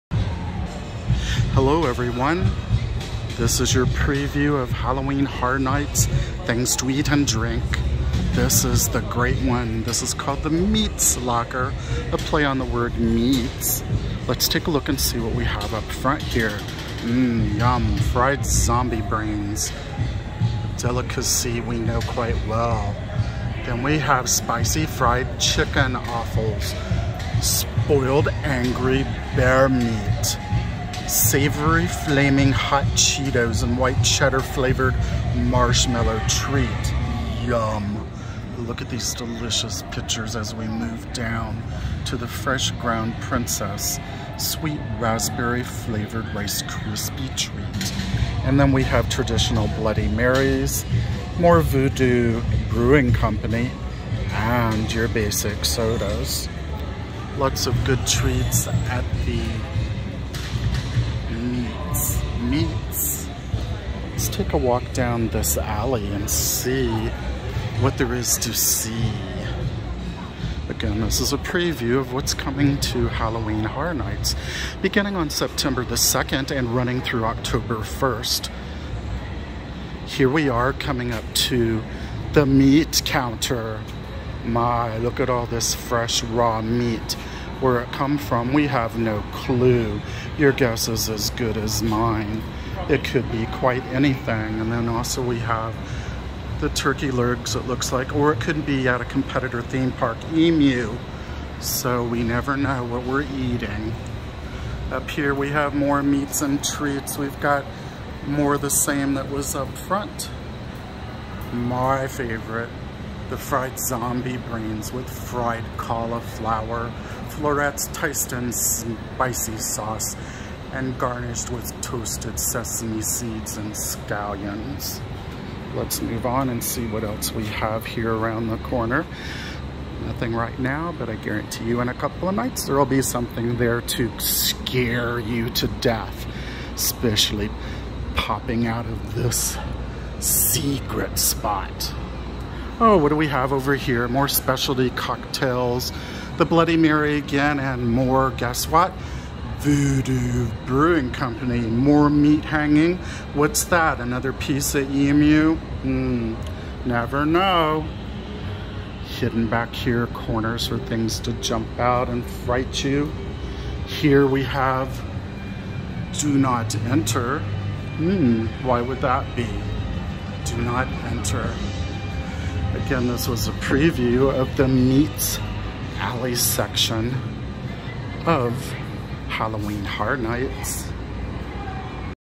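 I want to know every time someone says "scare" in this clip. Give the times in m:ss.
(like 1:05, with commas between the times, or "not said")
2:14.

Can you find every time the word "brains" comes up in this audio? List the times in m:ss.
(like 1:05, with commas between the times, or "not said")
0:19, 1:54.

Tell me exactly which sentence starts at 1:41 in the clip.
So we never know what we're eating.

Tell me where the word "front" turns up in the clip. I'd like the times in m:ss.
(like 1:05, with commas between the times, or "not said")
0:15, 1:49.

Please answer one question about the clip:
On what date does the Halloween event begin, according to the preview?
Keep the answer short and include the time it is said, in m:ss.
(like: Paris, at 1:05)
September 2nd, at 1:15.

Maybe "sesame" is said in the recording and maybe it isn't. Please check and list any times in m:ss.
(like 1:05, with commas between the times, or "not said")
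2:02.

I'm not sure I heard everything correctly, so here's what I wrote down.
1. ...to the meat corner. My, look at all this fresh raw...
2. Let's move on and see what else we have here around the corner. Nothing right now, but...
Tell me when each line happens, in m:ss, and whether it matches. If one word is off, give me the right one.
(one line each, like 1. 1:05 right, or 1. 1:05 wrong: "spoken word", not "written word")
1. 1:21 wrong: "counter", not "corner"
2. 2:05 right.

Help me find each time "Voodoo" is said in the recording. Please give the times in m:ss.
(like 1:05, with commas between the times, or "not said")
0:51, 2:29.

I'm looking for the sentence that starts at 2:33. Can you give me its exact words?
What's that, another piece of emu?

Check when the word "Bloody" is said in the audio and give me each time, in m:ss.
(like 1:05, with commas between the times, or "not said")
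0:49, 2:26.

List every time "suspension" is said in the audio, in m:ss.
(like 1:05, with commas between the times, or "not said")
not said.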